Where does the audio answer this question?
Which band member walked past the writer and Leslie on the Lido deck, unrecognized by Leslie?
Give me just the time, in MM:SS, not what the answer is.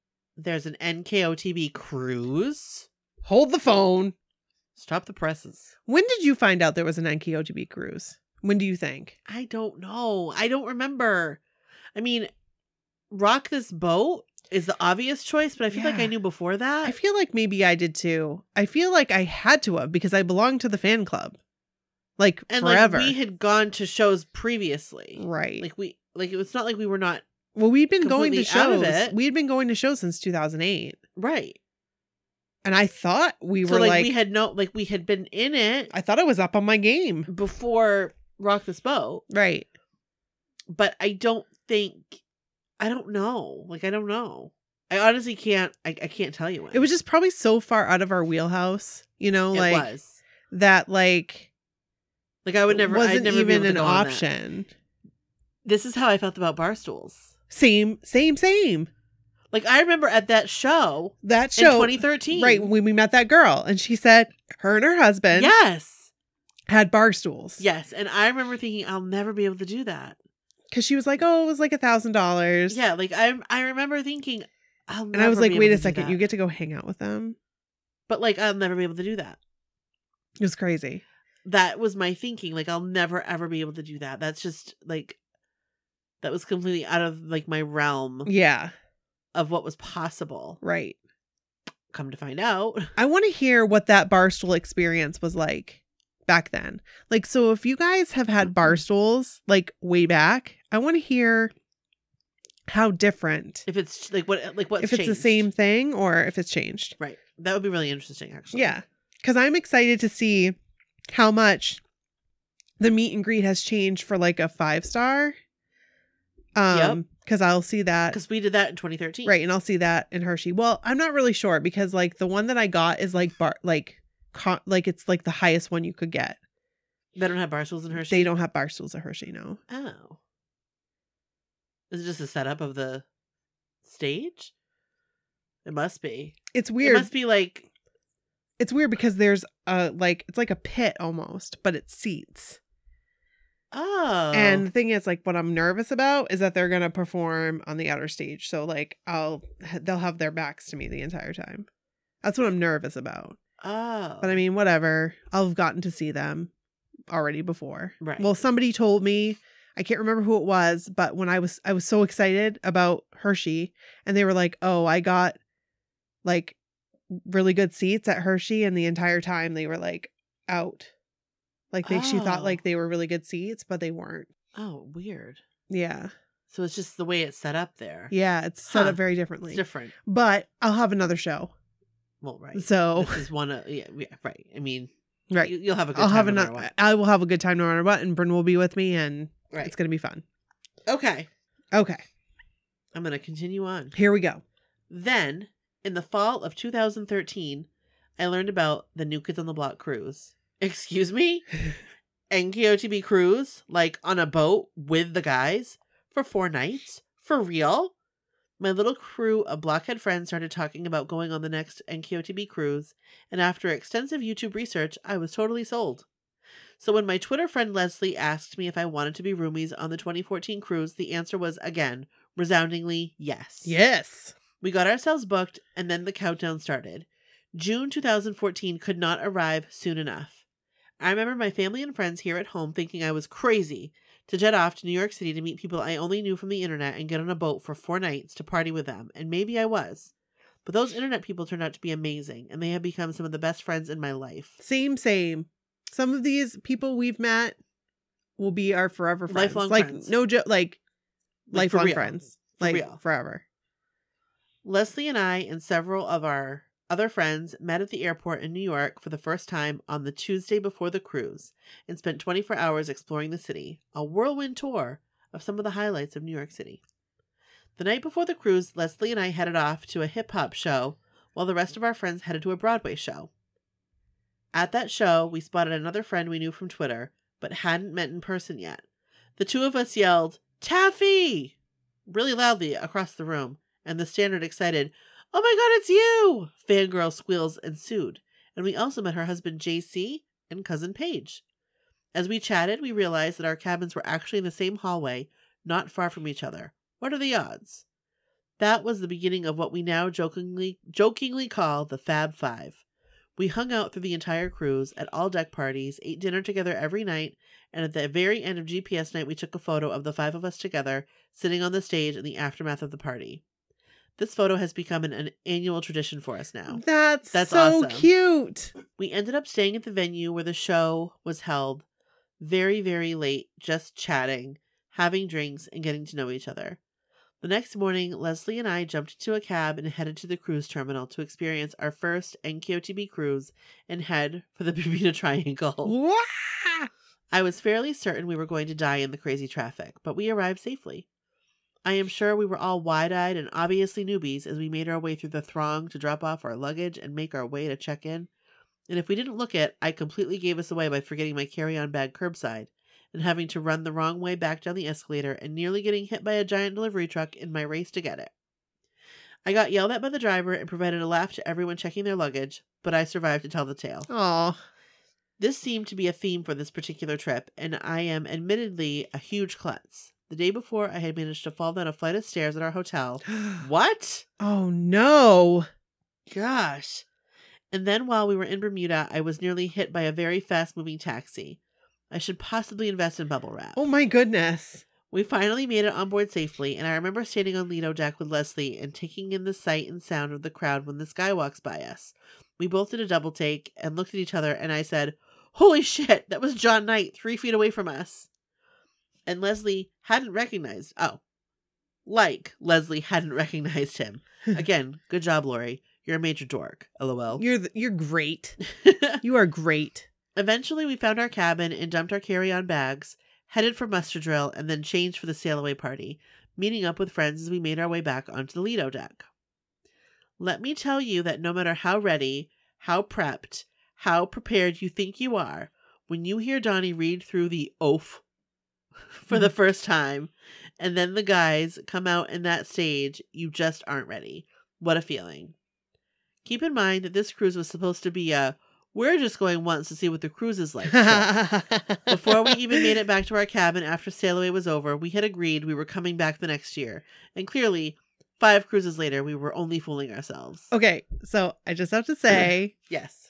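06:36.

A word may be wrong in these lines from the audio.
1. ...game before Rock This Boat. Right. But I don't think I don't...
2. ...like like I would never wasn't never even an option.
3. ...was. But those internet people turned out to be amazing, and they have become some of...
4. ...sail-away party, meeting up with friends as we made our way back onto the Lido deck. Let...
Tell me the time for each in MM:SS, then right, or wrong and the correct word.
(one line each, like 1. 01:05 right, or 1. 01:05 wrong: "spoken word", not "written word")
1. 00:36 right
2. 00:50 right
3. 03:59 right
4. 06:55 right.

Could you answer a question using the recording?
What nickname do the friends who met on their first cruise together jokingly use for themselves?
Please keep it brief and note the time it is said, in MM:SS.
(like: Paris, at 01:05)
Fab Five, at 05:01.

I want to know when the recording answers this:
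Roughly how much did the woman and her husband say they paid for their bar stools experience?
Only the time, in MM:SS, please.
01:11.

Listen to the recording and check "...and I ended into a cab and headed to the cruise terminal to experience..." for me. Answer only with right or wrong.
wrong.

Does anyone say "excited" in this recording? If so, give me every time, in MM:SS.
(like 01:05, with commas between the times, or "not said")
01:49, 02:42, 04:44.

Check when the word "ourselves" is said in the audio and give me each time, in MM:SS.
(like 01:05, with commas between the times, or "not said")
03:44, 07:30.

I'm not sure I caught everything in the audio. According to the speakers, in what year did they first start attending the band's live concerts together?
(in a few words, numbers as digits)
2008.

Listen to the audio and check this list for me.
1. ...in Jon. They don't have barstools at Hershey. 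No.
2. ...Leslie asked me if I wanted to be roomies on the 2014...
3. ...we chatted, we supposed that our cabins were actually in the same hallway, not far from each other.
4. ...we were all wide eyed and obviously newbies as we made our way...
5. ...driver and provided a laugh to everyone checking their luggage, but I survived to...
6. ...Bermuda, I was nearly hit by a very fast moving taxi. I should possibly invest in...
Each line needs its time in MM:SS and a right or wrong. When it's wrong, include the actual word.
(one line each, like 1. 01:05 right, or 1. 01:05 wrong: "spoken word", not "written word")
1. 02:07 wrong: "Hershey", not "Jon"
2. 03:37 right
3. 04:52 wrong: "realized", not "supposed"
4. 05:42 right
5. 06:00 right
6. 06:18 right.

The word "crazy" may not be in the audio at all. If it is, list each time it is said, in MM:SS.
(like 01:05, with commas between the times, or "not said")
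01:20, 03:53, 05:39.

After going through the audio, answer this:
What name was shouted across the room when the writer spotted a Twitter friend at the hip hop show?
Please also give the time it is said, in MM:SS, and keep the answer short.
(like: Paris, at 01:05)
Taffy, at 04:40.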